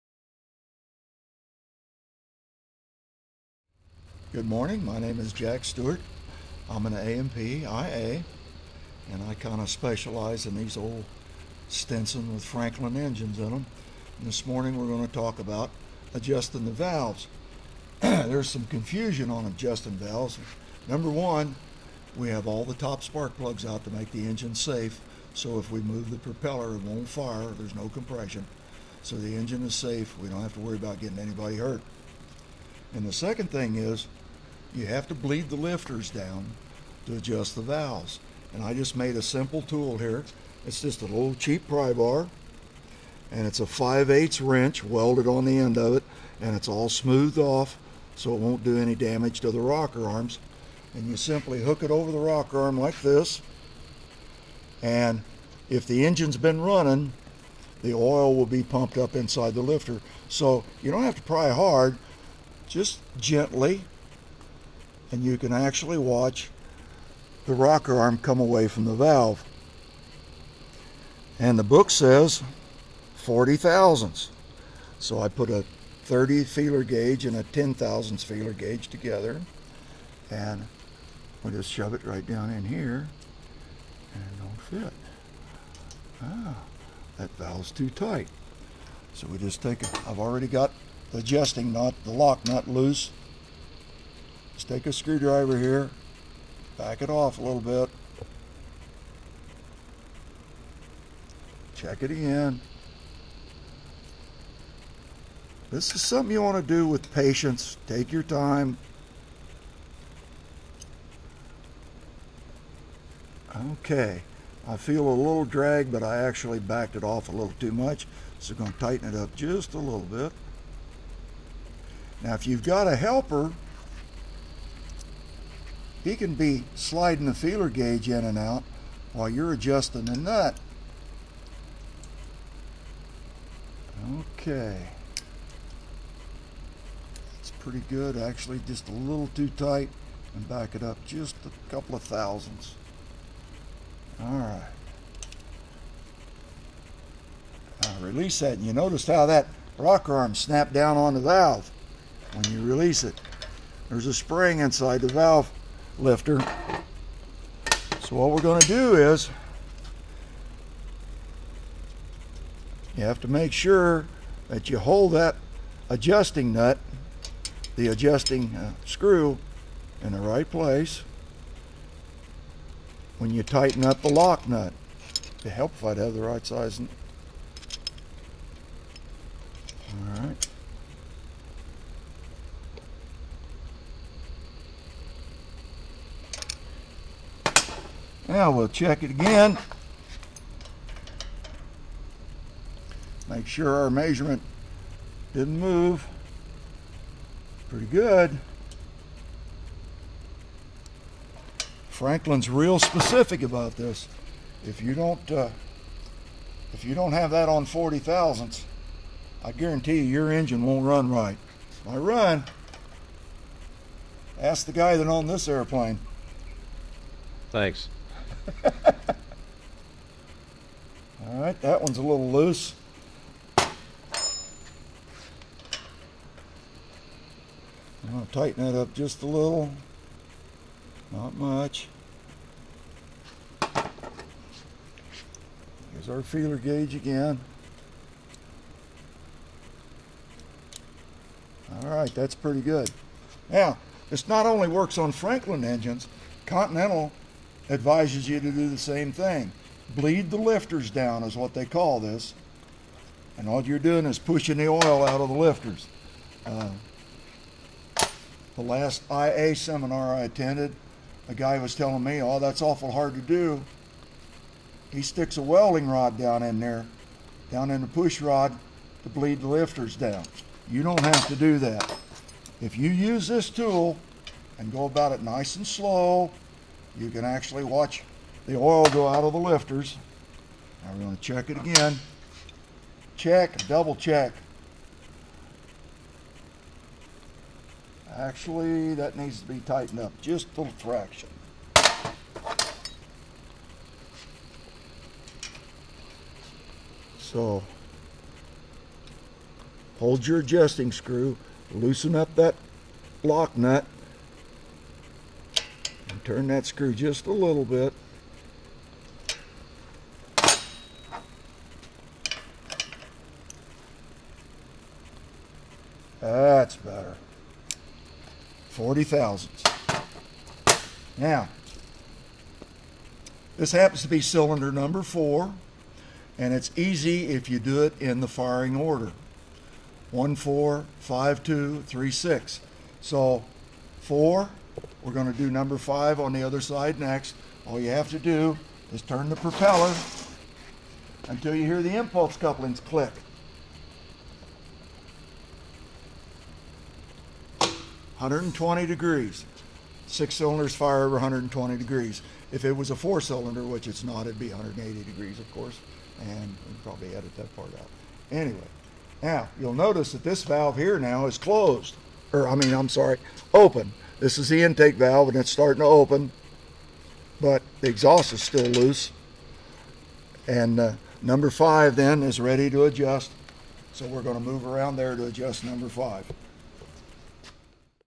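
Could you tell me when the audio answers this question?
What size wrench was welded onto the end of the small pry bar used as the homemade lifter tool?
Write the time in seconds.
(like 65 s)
43 s.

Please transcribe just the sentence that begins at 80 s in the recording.
And we just shove it right down in here.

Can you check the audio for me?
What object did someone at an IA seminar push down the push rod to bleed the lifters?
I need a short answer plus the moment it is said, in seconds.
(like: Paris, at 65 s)
welding rod, at 265 s.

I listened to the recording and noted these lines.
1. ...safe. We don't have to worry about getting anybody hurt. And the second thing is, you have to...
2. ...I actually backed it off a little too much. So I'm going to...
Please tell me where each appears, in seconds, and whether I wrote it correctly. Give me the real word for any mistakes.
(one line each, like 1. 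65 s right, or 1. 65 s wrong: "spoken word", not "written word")
1. 29 s right
2. 116 s right.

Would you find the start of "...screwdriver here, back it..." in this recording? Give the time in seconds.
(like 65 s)
94 s.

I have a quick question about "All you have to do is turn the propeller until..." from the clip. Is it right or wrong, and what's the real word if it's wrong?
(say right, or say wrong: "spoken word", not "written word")
right.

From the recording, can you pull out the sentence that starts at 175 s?
It'd help if I'd have the right size.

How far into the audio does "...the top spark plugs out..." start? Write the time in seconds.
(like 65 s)
22 s.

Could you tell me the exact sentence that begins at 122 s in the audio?
Now, if you've got a helper, he can be sliding the feeler gauge in and out while you're adjusting the nut.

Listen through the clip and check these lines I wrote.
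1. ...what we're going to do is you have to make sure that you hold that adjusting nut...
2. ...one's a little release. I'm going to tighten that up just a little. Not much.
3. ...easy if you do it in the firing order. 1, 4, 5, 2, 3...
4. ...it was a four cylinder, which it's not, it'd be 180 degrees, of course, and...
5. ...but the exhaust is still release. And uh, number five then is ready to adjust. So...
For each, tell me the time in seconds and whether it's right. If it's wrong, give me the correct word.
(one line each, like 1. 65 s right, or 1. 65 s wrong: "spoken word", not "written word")
1. 158 s right
2. 221 s wrong: "loose", not "release"
3. 326 s right
4. 352 s right
5. 367 s wrong: "loose", not "release".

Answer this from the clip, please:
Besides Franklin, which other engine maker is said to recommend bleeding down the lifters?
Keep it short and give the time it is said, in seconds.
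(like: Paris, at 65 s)
Continental, at 246 s.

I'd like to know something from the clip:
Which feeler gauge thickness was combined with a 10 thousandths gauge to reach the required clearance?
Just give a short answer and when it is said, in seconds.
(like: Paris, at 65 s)
30, at 76 s.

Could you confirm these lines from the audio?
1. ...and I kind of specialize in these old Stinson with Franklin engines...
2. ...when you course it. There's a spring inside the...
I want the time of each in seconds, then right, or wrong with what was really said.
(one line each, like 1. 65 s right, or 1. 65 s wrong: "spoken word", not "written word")
1. 9 s right
2. 152 s wrong: "release", not "course".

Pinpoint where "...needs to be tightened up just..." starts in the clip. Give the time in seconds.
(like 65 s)
289 s.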